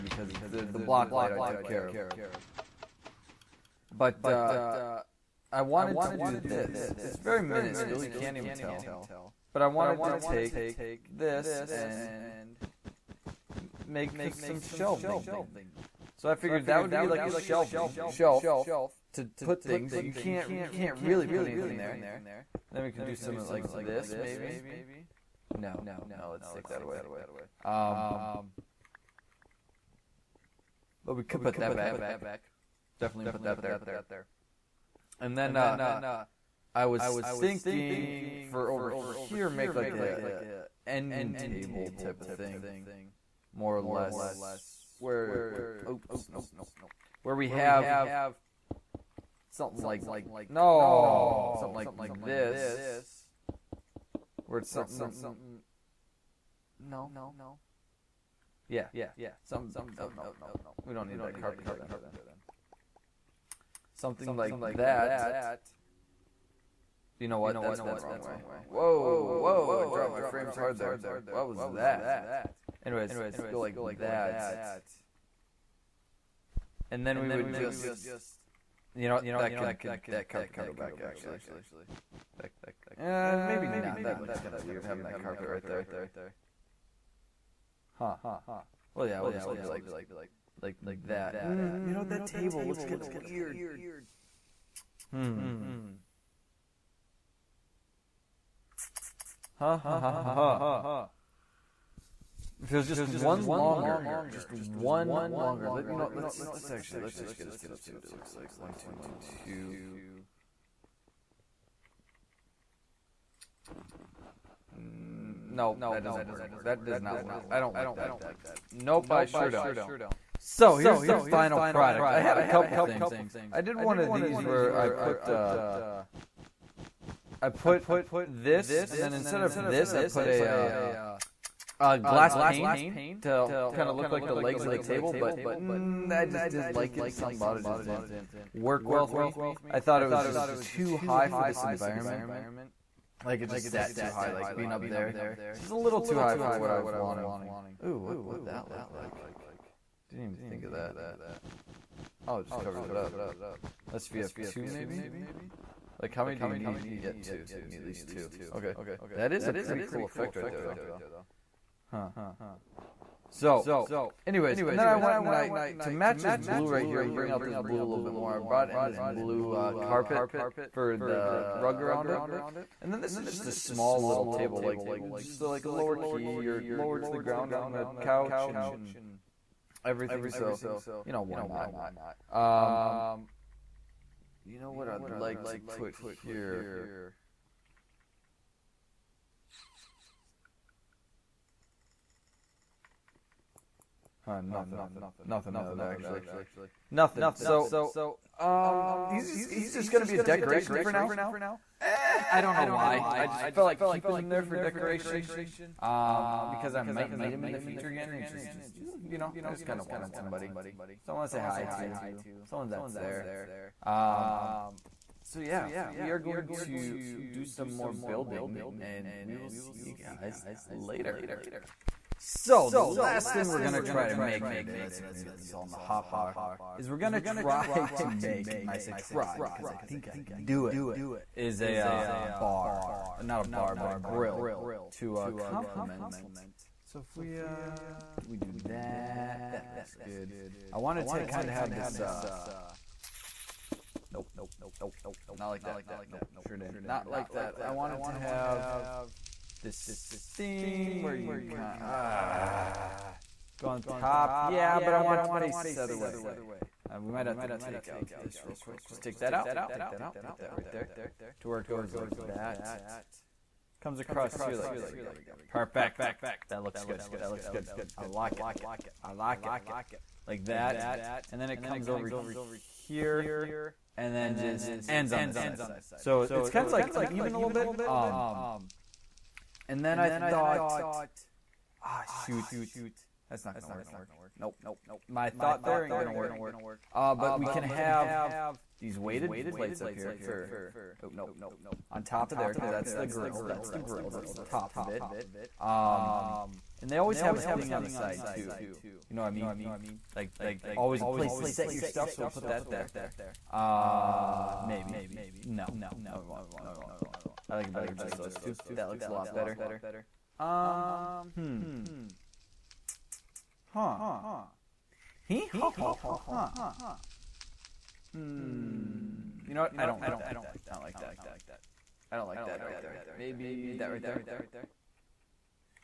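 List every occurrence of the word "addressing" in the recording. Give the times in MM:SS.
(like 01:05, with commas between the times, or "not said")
not said.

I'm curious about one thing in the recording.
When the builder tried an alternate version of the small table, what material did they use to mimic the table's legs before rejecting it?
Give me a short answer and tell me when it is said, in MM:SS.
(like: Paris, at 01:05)
glass pane, at 02:11.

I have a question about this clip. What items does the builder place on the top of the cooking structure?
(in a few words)
weighted plates.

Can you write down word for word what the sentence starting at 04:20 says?
Put that right there to where it goes like that.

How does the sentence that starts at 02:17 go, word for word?
Some about it just didn't work well with me.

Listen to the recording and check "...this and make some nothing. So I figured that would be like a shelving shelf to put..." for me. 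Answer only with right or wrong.
wrong.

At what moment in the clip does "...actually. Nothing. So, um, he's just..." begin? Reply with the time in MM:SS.
03:15.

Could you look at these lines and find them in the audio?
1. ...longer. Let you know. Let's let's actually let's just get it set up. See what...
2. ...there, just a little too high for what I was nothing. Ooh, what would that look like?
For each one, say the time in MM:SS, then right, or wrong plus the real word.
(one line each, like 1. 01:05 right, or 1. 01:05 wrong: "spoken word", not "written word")
1. 01:45 right
2. 02:24 wrong: "wanting", not "nothing".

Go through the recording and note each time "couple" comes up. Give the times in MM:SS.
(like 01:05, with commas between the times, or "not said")
02:02.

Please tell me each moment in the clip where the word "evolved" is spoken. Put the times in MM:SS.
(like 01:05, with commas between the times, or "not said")
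not said.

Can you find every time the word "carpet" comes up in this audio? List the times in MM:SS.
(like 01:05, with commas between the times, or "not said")
01:01, 01:20, 01:25, 02:49.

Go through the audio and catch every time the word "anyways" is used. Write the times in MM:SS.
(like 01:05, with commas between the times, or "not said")
01:12, 02:44.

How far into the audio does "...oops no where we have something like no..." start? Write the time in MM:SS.
00:45.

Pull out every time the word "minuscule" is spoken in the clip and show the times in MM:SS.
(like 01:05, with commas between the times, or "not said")
00:07.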